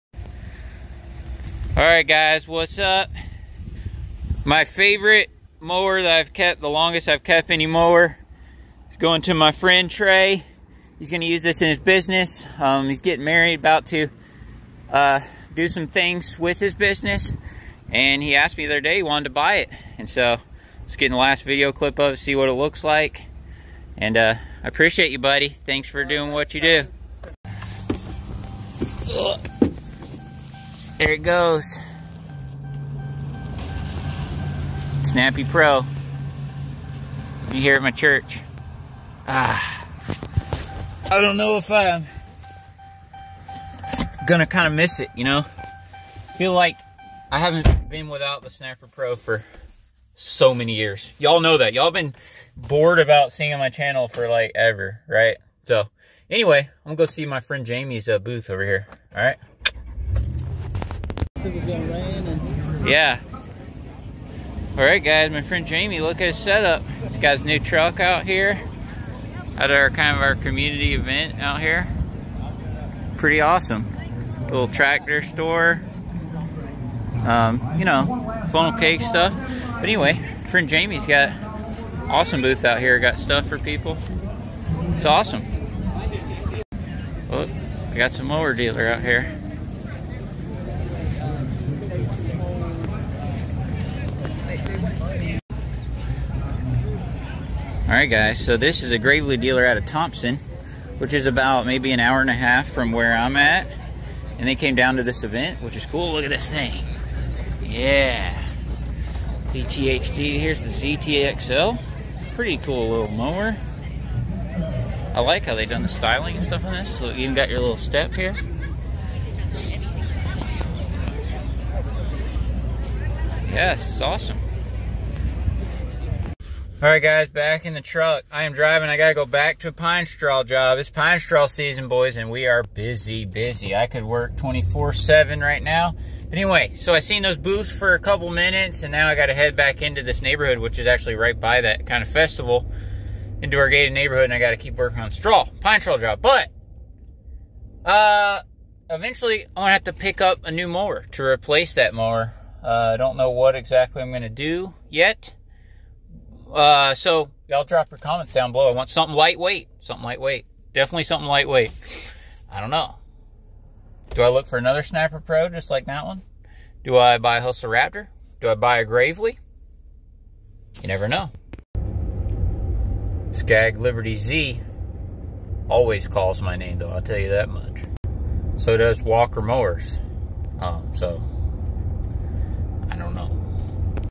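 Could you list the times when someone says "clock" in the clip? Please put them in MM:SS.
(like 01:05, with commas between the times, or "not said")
not said.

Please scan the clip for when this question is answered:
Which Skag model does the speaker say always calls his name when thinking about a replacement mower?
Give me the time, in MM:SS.
02:53.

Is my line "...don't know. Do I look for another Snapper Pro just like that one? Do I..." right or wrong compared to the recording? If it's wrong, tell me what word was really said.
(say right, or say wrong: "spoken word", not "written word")
right.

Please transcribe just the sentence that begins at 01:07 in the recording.
He's got his new truck out here.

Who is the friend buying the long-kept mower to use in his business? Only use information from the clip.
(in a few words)
Trey.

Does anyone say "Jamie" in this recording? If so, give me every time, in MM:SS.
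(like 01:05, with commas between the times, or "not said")
00:57, 01:05, 01:20.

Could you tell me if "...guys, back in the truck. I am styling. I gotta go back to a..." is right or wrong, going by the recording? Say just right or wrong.
wrong.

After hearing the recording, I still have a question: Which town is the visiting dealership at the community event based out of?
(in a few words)
Thompson.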